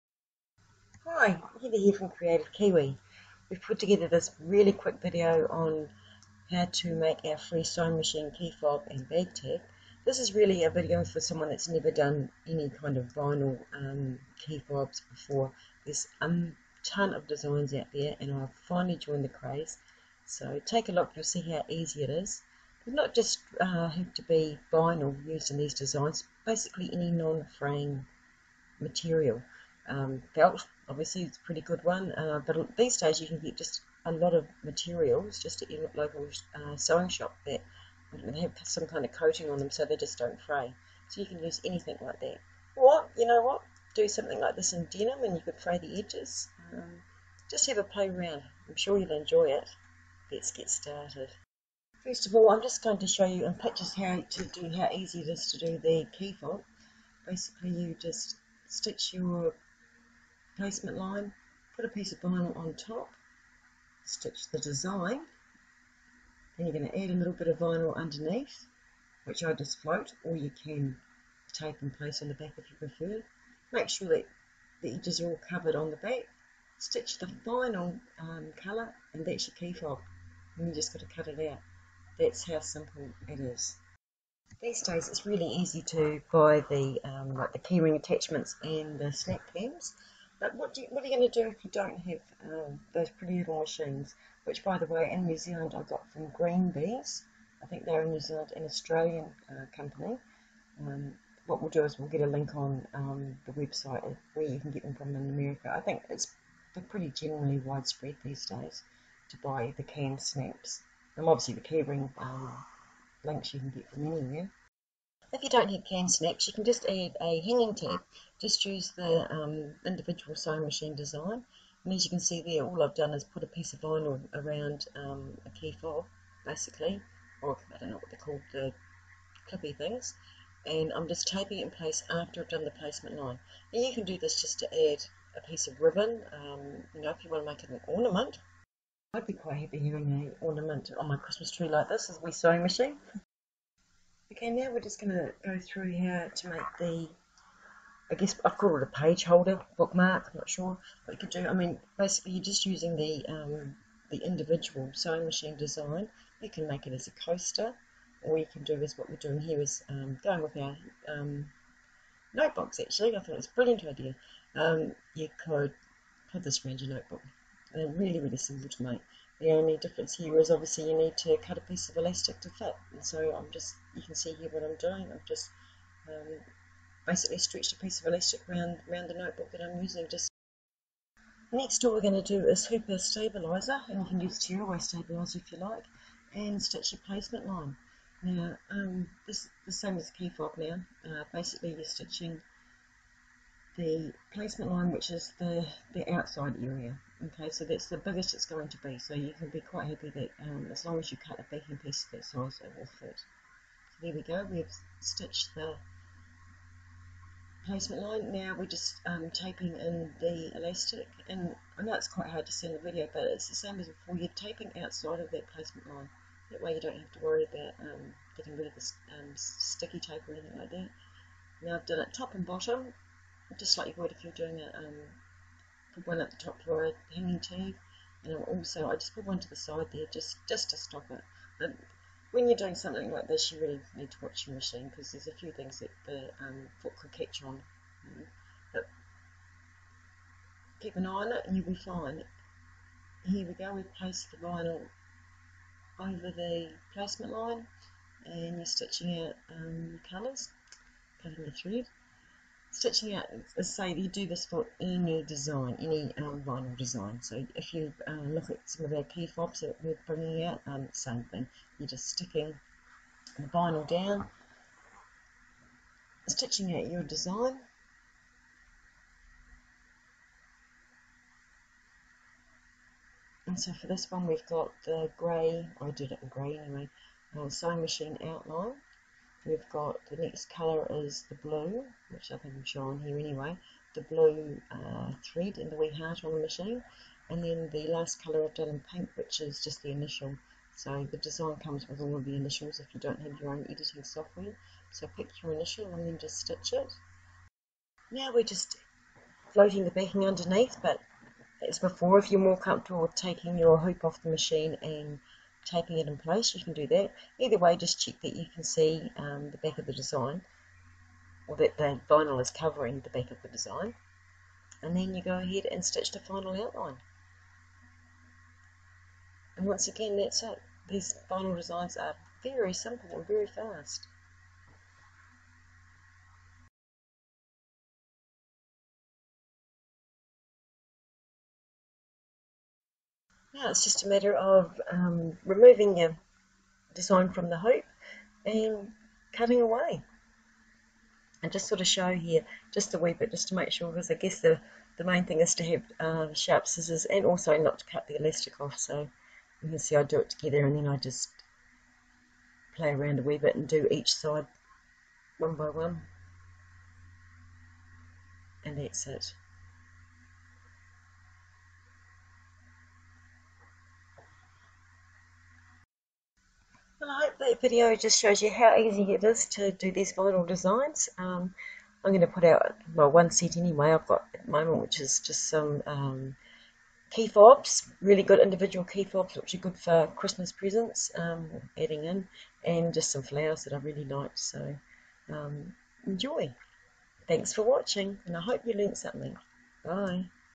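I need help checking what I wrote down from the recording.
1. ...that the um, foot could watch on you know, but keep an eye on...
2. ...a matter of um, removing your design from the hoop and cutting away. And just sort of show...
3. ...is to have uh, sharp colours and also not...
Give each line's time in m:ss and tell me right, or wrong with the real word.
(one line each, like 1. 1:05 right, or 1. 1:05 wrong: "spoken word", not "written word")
1. 3:55 wrong: "catch", not "watch"
2. 5:34 right
3. 5:45 wrong: "scissors", not "colours".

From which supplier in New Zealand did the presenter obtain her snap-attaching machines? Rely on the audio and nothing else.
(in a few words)
Greenbees.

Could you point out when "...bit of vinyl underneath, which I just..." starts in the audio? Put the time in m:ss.
1:07.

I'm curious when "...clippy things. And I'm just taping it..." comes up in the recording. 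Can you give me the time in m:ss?
2:09.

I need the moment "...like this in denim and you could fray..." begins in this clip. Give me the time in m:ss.
0:44.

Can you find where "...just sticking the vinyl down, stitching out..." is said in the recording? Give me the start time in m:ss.
4:21.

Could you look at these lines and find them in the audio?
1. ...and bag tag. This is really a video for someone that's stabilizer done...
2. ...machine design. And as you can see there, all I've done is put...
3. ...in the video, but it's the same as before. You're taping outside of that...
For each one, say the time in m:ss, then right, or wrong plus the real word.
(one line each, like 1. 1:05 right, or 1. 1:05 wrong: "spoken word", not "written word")
1. 0:08 wrong: "never", not "stabilizer"
2. 2:00 right
3. 3:32 right.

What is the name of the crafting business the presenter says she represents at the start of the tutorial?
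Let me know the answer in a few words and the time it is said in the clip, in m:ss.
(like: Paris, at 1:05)
Kreative Kiwi, at 0:02.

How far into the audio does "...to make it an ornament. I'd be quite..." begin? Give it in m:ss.
2:17.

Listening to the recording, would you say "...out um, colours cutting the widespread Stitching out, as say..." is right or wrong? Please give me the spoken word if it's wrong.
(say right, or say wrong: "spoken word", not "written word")
wrong: "thread", not "widespread".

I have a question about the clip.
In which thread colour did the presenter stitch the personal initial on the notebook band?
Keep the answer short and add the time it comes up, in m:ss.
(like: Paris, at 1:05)
Pink, at 4:48.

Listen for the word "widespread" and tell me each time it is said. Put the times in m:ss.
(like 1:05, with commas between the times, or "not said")
1:47.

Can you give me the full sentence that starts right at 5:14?
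And then you go ahead and stitch the final outline.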